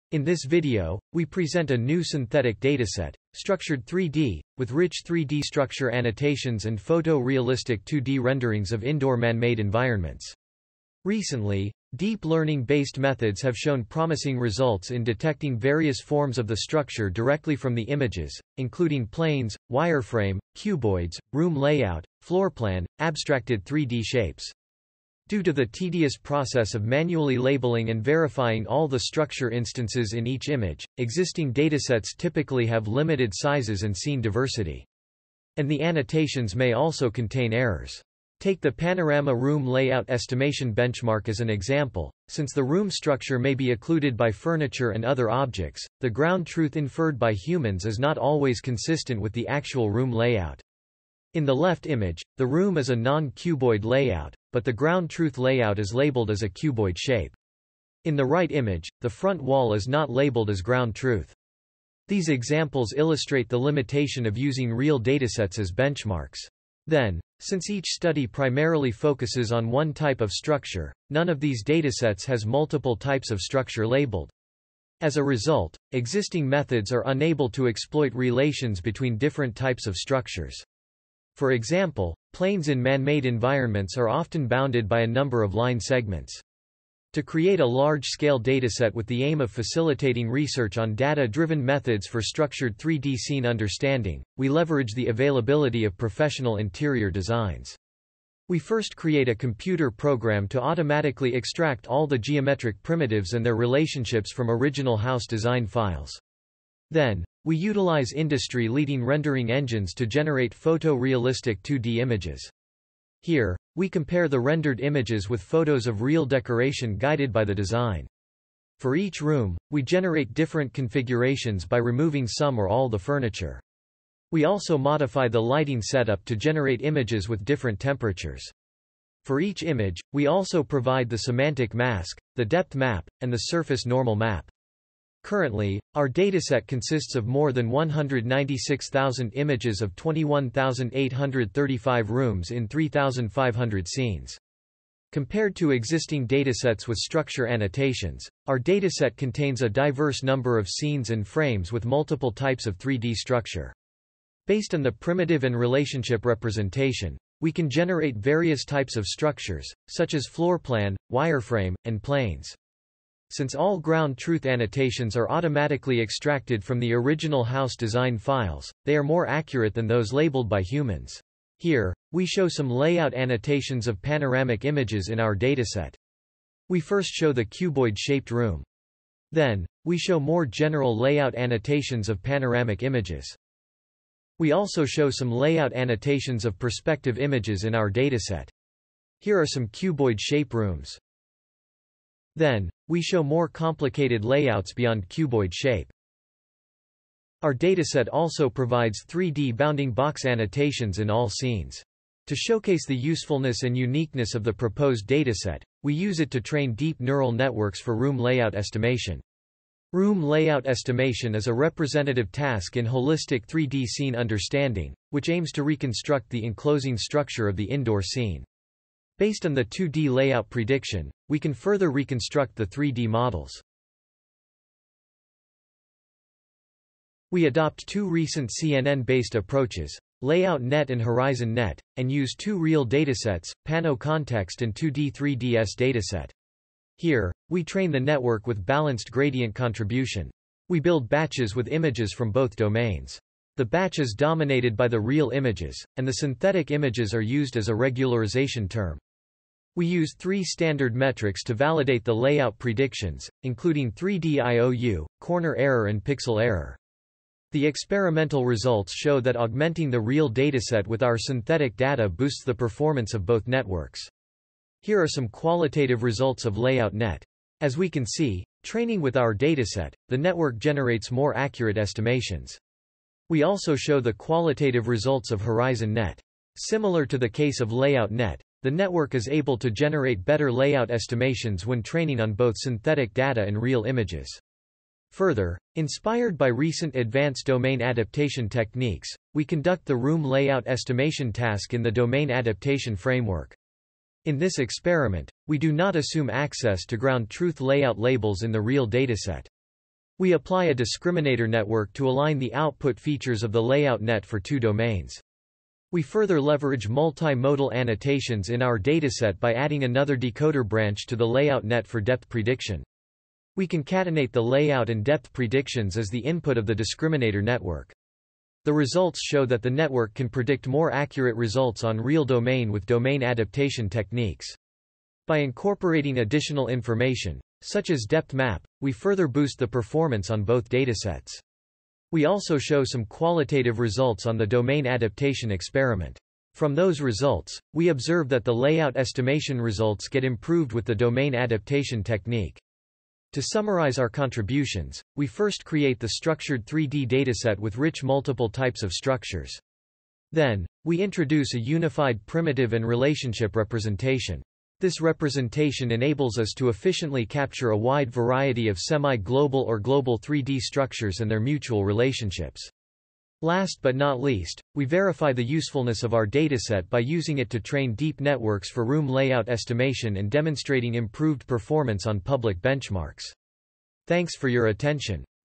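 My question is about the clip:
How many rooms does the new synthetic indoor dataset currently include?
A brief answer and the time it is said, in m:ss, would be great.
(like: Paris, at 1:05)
21,835, at 2:19.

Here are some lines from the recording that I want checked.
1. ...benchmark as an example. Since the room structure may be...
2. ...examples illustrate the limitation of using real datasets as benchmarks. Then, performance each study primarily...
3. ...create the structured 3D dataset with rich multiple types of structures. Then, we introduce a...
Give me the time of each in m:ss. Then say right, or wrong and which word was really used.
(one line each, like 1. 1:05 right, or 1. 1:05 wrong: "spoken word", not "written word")
1. 0:40 right
2. 1:02 wrong: "since", not "performance"
3. 5:45 right.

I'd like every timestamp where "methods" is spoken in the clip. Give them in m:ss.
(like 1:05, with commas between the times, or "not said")
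0:12, 1:16, 1:31.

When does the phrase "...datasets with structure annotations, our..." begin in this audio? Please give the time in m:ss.
2:26.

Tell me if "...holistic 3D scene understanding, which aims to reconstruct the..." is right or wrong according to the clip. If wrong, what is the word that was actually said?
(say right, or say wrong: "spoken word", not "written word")
right.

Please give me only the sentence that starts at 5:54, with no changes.
This representation enables us to efficiently capture a wide variety of semi-global or global 3D structures and their mutual relationships.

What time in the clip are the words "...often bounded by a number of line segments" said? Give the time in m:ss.
1:24.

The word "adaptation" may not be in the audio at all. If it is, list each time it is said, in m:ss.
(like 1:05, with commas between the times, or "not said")
4:47, 4:52, 5:23, 5:34, 5:41.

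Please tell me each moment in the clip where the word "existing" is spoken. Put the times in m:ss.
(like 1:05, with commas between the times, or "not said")
0:30, 1:15, 2:25.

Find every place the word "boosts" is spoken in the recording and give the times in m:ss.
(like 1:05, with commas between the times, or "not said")
4:22, 5:29.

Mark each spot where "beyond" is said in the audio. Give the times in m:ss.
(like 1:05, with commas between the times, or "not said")
3:14.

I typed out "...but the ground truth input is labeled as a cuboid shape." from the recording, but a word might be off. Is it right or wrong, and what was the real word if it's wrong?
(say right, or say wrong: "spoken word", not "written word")
wrong: "layout", not "input".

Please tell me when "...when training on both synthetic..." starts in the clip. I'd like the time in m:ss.
4:41.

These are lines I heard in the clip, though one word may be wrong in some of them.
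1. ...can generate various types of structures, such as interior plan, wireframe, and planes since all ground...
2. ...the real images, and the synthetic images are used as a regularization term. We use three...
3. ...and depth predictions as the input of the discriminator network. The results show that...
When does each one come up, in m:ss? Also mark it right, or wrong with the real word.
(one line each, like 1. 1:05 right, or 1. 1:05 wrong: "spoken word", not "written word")
1. 2:37 wrong: "floor", not "interior"
2. 4:04 right
3. 5:14 right.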